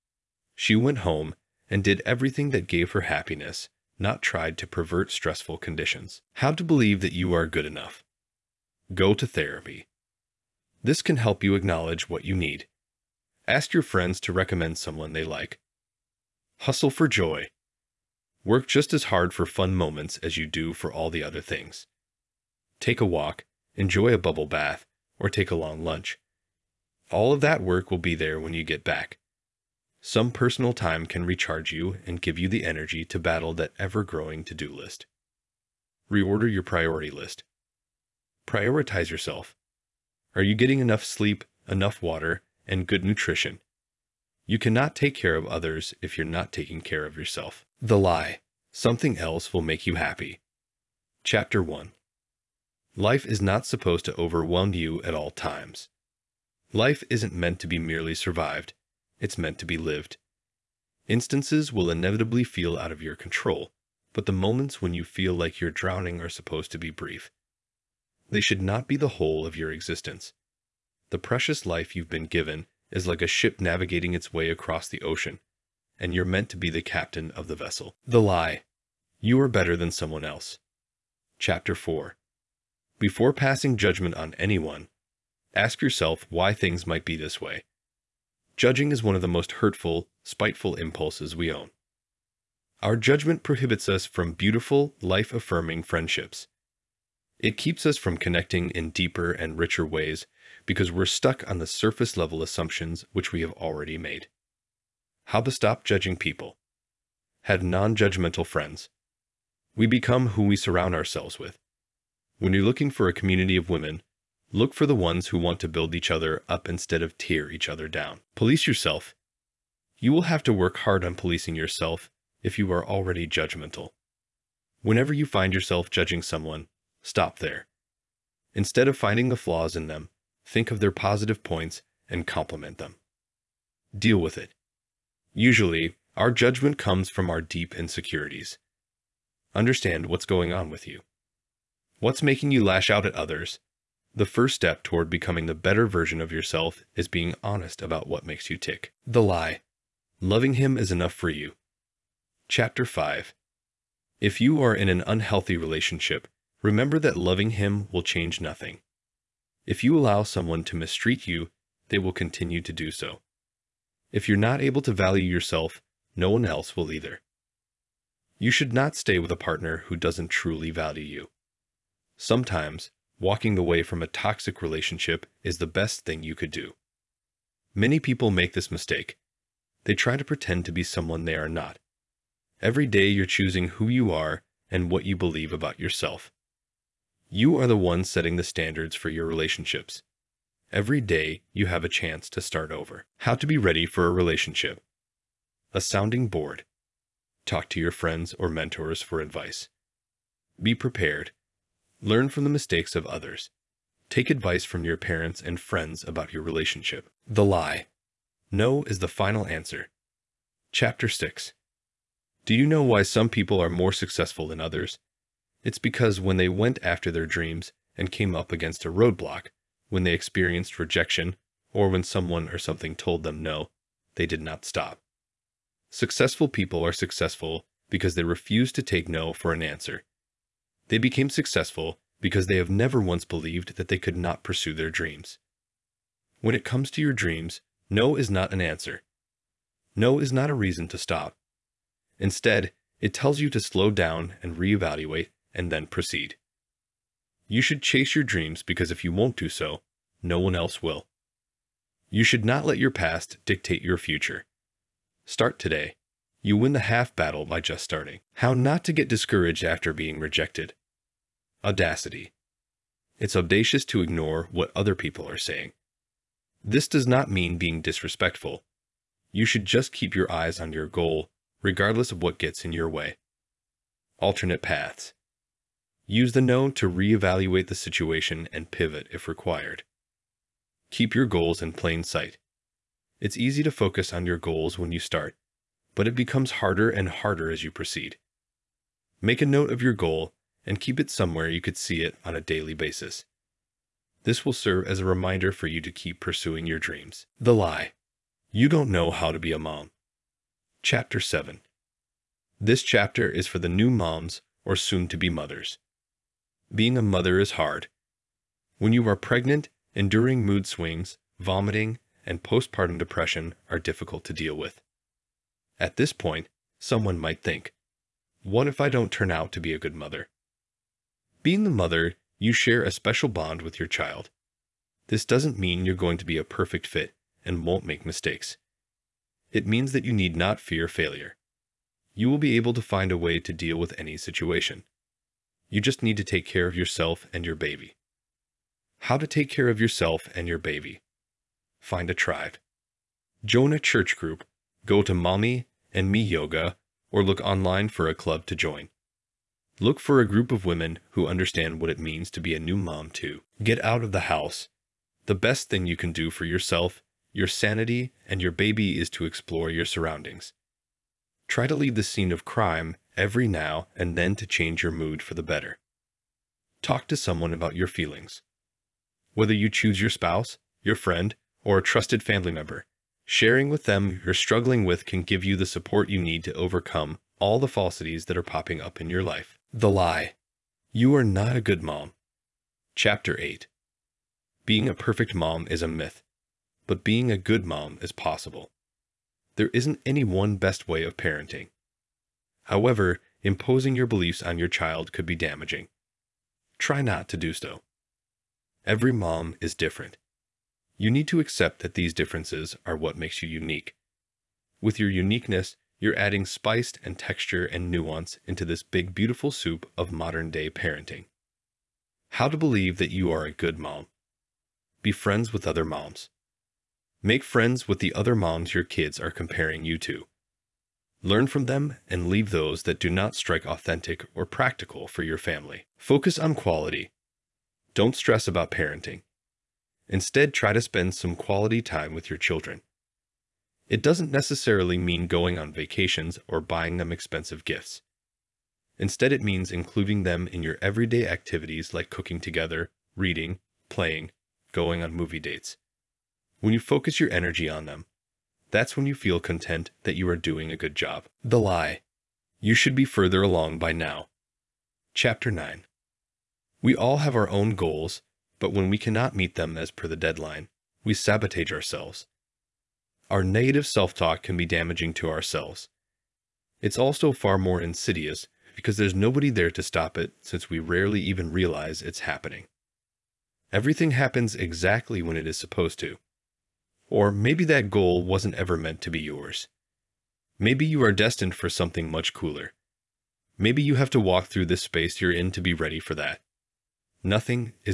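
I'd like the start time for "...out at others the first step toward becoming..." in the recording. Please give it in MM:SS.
02:22.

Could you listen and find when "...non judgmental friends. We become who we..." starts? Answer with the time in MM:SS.
01:47.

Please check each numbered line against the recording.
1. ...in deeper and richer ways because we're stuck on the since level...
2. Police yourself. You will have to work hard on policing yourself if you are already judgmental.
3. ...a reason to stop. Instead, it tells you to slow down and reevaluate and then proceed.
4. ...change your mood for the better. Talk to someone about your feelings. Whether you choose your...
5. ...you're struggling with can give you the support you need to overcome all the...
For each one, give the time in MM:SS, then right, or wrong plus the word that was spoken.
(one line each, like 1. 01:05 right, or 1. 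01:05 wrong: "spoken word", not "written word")
1. 01:38 wrong: "surface", not "since"
2. 01:58 right
3. 04:00 right
4. 06:04 right
5. 06:14 right.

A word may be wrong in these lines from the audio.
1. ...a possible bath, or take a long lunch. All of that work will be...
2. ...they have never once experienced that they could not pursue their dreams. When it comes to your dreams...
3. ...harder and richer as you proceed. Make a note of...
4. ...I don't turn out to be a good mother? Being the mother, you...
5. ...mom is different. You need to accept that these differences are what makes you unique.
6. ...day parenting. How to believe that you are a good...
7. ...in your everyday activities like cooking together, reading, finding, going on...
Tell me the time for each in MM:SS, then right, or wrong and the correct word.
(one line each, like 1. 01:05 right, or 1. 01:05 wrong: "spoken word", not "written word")
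1. 00:24 wrong: "bubble", not "possible"
2. 03:52 wrong: "believed", not "experienced"
3. 04:46 wrong: "harder", not "richer"
4. 05:18 right
5. 06:39 right
6. 06:50 right
7. 07:20 wrong: "playing", not "finding".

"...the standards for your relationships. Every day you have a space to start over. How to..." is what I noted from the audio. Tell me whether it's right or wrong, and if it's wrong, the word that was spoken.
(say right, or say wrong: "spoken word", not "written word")
wrong: "chance", not "space".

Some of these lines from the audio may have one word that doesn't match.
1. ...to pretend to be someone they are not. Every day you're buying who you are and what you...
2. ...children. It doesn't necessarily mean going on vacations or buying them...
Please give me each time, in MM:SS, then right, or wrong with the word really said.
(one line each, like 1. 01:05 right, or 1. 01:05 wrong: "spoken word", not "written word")
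1. 03:00 wrong: "choosing", not "buying"
2. 07:12 right.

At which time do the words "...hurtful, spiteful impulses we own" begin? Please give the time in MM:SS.
01:29.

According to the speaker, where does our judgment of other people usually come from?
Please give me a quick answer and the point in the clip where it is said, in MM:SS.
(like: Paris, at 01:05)
Deep insecurities, at 02:17.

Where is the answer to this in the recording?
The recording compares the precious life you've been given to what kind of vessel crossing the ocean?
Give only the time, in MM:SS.
01:13.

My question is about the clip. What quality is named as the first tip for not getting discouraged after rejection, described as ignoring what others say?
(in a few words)
Audacity.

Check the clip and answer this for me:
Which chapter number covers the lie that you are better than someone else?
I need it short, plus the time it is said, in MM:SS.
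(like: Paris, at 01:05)
4, at 01:21.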